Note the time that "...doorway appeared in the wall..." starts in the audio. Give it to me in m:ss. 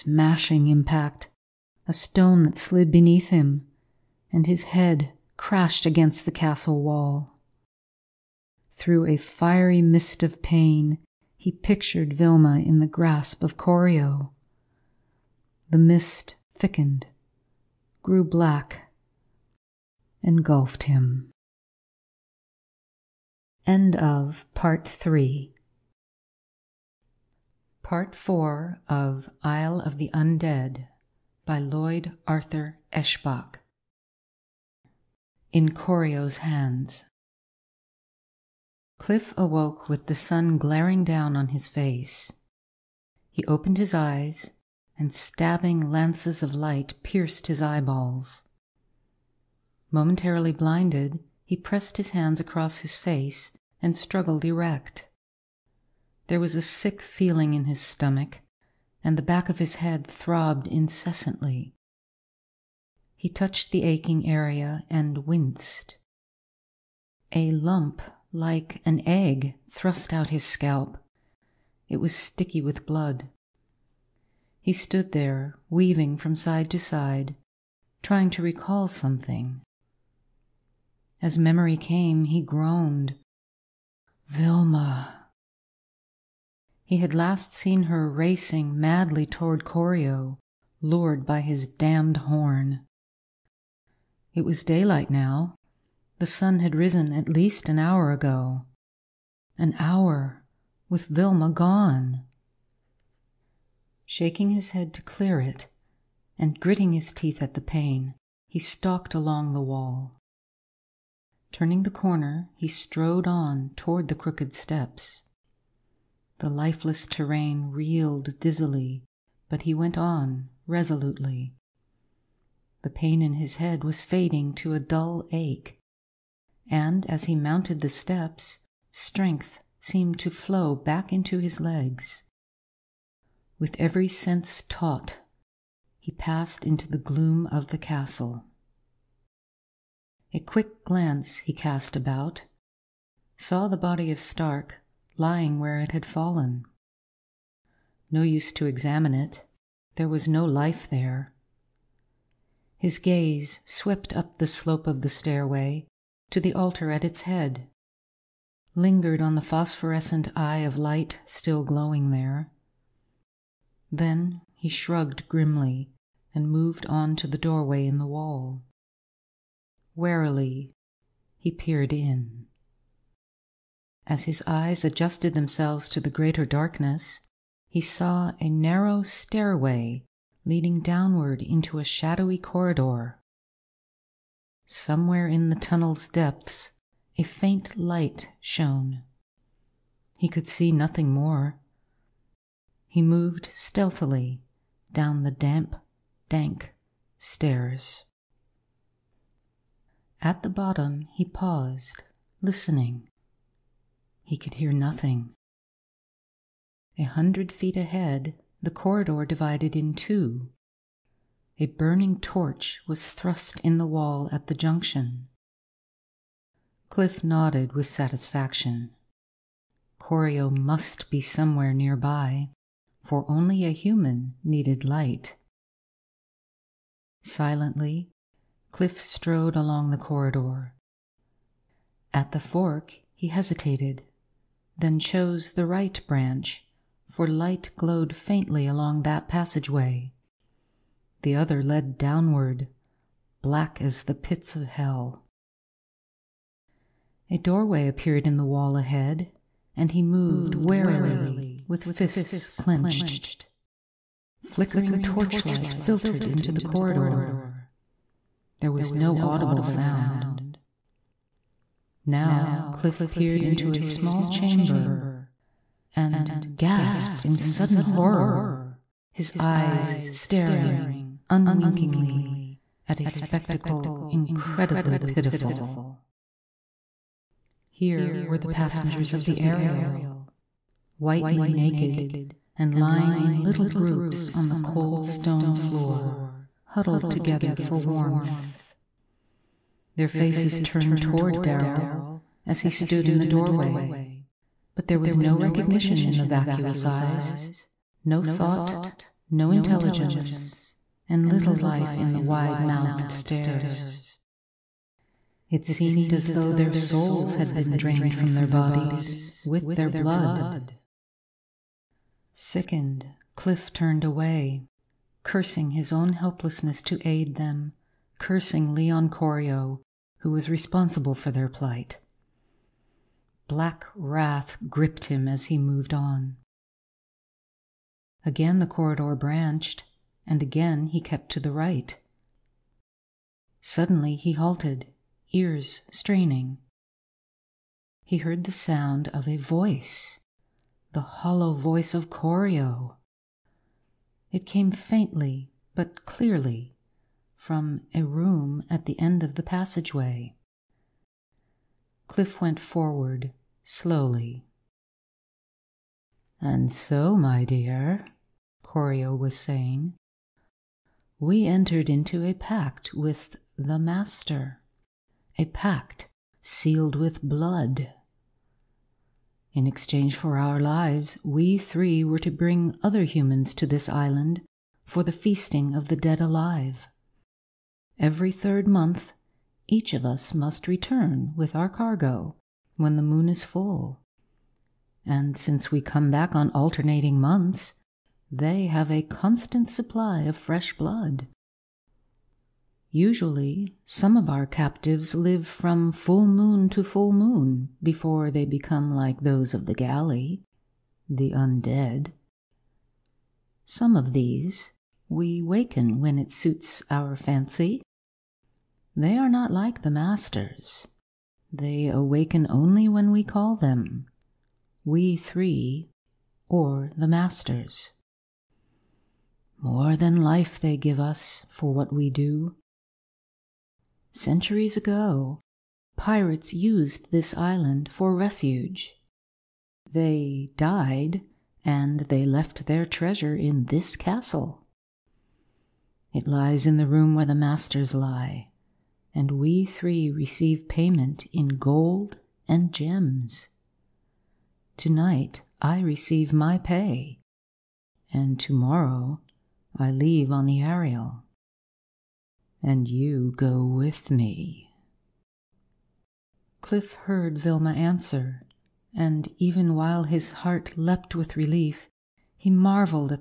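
4:07.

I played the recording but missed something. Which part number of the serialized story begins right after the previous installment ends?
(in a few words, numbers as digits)
4.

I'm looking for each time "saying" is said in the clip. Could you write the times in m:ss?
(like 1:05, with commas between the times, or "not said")
5:59.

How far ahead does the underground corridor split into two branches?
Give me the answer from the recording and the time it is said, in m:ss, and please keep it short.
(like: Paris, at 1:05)
100 feet, at 3:26.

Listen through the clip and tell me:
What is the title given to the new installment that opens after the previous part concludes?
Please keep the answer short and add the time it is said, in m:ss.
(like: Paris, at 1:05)
In Corio's Hands, at 0:35.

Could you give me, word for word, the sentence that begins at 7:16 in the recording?
It lies in the room where the masters lie, and we three receive payment in gold and gems.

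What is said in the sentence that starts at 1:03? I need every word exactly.
He touched the aching area and winced.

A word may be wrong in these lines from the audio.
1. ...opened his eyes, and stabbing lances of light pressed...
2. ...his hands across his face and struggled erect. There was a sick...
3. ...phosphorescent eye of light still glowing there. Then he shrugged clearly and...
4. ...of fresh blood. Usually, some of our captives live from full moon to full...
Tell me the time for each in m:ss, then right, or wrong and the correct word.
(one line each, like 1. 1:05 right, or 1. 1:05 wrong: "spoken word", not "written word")
1. 0:43 wrong: "pierced", not "pressed"
2. 0:51 right
3. 2:39 wrong: "grimly", not "clearly"
4. 6:30 right.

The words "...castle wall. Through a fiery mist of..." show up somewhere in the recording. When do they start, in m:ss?
0:06.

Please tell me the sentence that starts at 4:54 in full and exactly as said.
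But there was no recognition in the vacuous eyes, no thought, no intelligence, and little life in the wide-mouthed stares.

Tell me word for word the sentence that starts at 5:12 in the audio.
Sickened, Cliff turned away, cursing his own helplessness to aid them cursing Leon Corio, who was responsible for their plight.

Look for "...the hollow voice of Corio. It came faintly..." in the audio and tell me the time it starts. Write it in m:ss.
5:40.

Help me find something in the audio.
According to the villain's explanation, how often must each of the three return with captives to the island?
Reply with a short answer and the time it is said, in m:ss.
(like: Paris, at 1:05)
Every third month, at 6:17.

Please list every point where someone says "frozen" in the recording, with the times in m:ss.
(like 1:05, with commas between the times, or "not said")
not said.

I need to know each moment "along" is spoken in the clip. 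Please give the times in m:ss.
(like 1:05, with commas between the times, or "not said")
1:49, 3:49, 3:58.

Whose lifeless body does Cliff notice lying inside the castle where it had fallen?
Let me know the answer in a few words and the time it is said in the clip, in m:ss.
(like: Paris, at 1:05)
Stark, at 2:24.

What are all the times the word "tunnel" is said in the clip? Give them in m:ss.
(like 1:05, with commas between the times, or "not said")
3:05.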